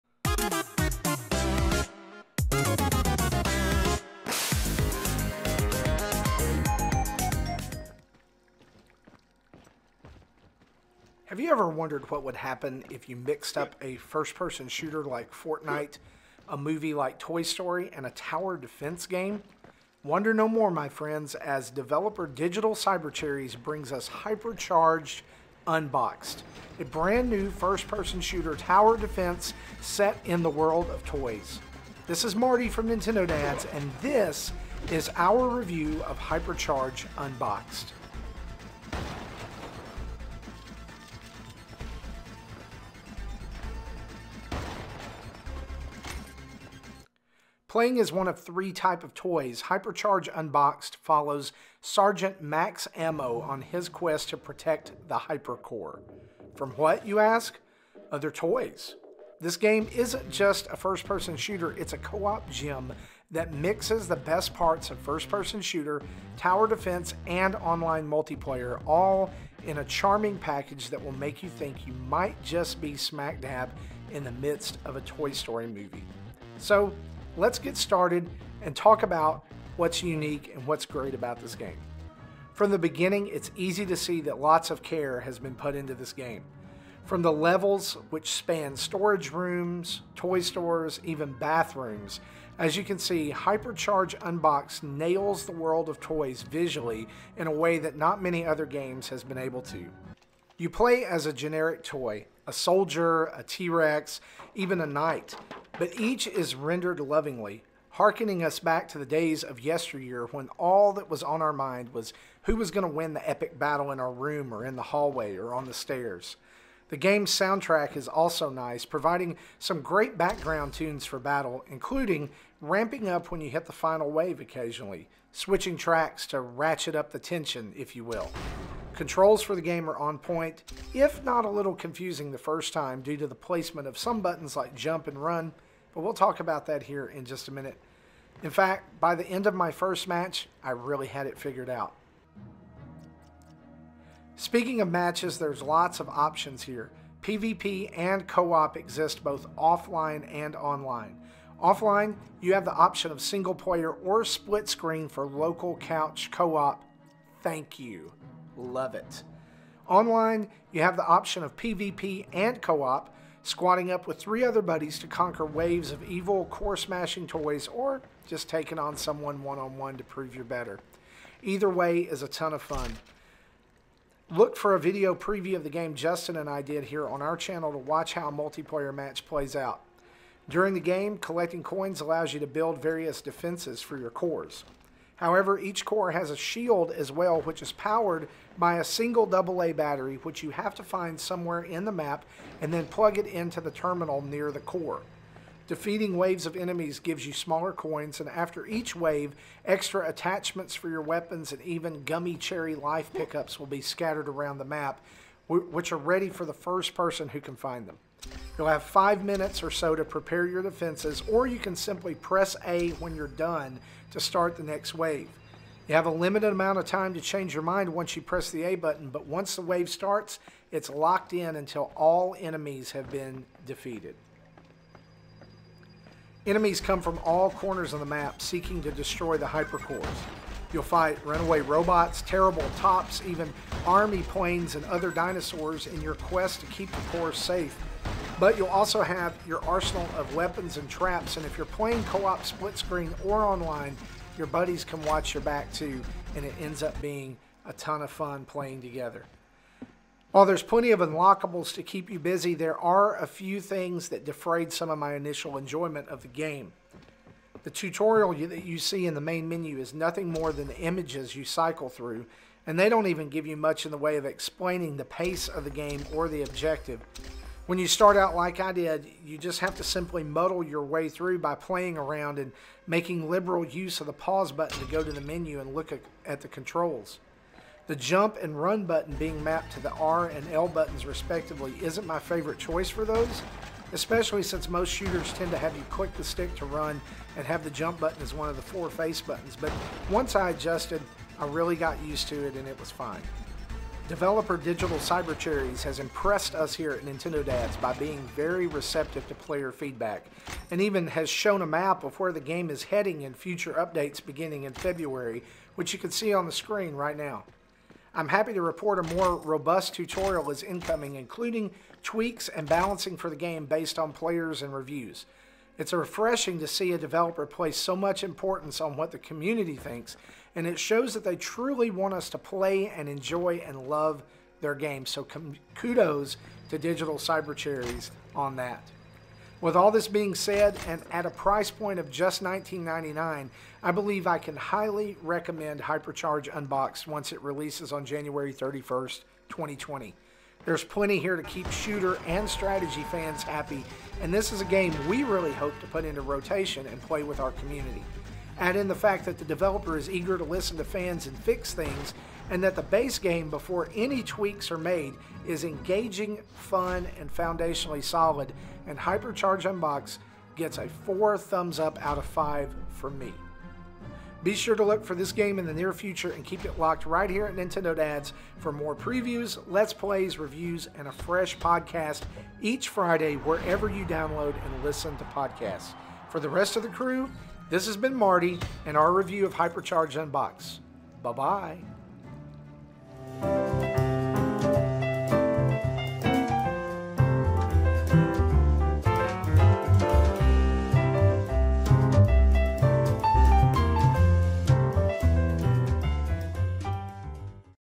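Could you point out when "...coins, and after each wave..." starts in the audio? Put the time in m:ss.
3:17.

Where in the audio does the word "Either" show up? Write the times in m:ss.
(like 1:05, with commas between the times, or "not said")
2:51.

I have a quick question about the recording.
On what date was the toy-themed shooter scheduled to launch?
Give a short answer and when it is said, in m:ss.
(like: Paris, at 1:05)
January 31st, 2020, at 5:38.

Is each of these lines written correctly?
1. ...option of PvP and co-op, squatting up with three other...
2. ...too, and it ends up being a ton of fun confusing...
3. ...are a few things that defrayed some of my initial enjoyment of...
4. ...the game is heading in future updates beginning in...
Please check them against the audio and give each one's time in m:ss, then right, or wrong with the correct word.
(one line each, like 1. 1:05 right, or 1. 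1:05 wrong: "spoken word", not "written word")
1. 2:41 right
2. 4:05 wrong: "playing", not "confusing"
3. 4:12 right
4. 5:02 right.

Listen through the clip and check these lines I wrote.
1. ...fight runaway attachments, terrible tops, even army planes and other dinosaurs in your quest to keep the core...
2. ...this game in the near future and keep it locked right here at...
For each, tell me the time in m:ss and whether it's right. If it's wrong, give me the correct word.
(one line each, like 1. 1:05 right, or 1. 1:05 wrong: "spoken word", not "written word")
1. 3:50 wrong: "robots", not "attachments"
2. 6:05 right.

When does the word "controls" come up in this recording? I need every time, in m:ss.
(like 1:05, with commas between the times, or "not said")
2:08, 4:36.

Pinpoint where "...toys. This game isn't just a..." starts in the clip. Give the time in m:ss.
0:58.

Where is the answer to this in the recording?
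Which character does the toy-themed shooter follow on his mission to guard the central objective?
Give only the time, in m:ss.
0:51.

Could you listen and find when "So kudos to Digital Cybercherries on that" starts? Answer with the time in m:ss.
5:25.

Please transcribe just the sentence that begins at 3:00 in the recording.
During the game, collecting coins allows you to build various defenses for your cores.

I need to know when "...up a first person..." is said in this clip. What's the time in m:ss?
0:13.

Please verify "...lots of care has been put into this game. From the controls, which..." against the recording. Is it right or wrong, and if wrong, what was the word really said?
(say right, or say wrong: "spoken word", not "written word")
wrong: "levels", not "controls".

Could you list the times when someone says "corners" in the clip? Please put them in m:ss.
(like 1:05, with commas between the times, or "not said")
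3:47.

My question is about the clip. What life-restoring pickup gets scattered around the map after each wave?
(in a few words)
Gummy cherry.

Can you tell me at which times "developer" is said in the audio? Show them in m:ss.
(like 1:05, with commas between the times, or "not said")
0:21, 4:54, 5:16, 5:49.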